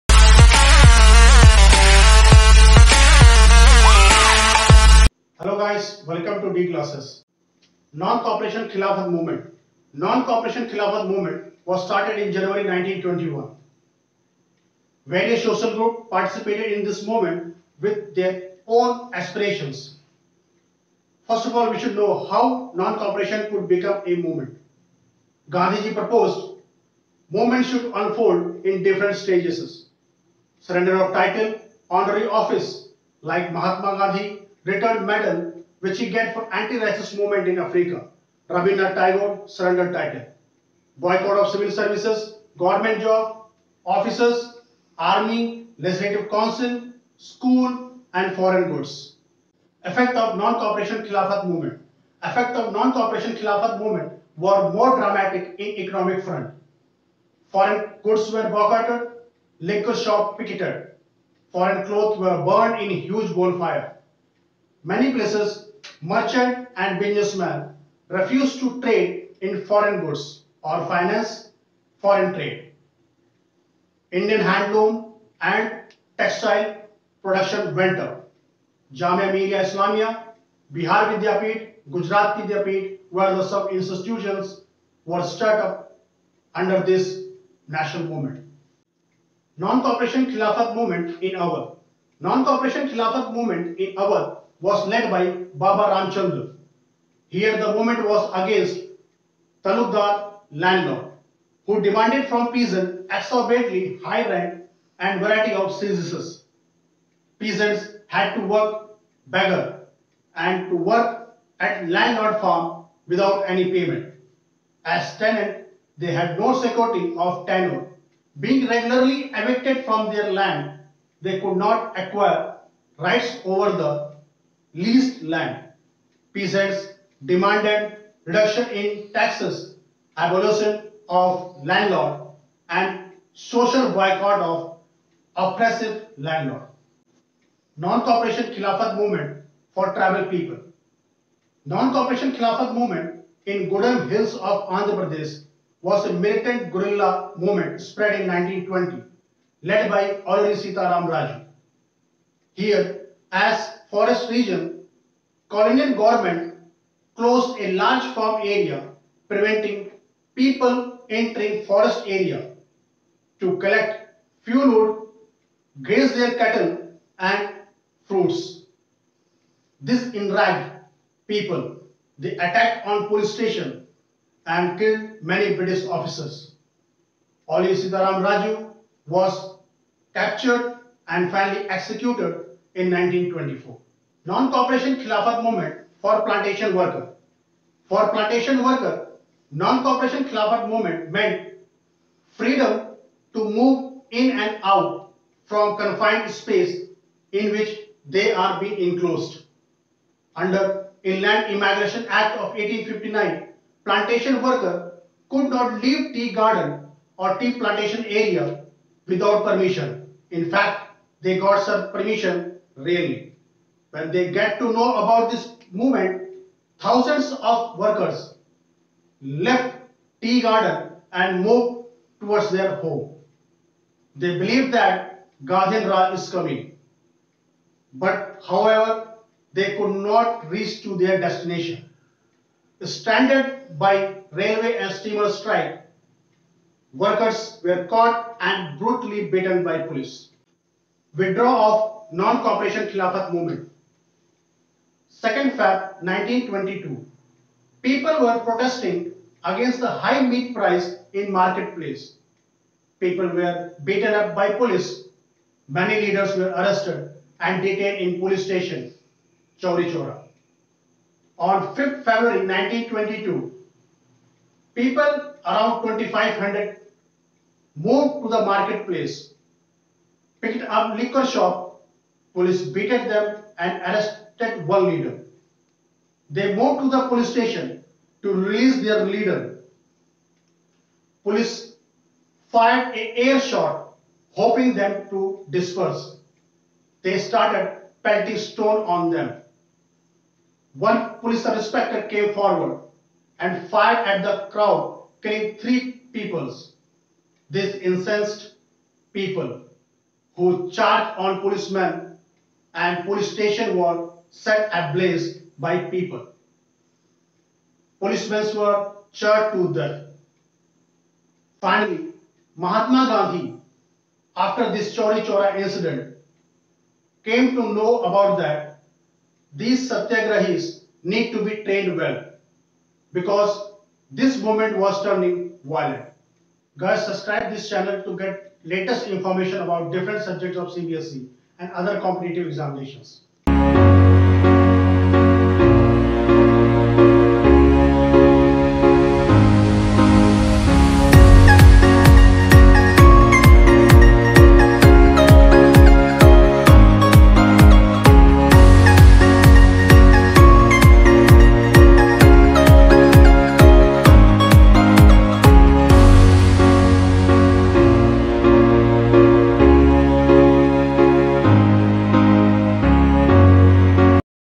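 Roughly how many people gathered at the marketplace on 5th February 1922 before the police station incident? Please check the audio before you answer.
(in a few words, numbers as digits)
2500.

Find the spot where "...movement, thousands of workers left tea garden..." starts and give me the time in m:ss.
3:35.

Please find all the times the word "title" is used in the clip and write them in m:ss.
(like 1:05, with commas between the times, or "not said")
0:31, 0:39.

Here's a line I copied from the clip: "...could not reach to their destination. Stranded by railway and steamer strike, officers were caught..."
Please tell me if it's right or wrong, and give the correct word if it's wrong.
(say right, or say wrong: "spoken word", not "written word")
wrong: "workers", not "officers".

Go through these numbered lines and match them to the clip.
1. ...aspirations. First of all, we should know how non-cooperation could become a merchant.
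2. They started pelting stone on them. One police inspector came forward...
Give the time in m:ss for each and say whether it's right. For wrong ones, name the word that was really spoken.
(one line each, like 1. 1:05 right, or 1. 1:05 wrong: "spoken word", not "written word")
1. 0:19 wrong: "movement", not "merchant"
2. 4:47 right.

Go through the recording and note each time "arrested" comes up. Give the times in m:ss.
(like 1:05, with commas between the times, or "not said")
4:16, 4:33.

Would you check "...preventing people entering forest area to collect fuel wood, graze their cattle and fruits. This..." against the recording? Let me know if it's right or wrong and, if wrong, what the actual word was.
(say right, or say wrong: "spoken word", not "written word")
right.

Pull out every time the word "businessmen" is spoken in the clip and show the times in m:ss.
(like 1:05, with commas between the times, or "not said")
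1:06.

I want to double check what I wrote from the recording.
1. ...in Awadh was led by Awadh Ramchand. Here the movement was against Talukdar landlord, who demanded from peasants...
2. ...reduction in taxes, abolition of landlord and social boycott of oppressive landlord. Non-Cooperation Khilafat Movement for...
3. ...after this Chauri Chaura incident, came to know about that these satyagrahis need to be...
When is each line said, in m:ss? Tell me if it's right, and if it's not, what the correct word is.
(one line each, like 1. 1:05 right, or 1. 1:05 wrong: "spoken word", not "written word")
1. 1:33 wrong: "Baba", not "Awadh"
2. 2:08 right
3. 5:14 right.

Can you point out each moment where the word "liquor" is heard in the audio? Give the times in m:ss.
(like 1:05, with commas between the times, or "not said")
0:59, 4:30.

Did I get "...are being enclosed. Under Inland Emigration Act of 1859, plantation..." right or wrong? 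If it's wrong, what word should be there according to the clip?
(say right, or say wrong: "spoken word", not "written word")
right.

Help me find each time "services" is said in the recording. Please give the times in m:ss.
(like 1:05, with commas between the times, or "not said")
0:41, 1:45.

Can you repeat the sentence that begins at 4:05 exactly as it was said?
2nd Feb 1922, people were protesting against the high meat price in marketplace.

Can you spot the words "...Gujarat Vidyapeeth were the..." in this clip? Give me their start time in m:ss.
1:21.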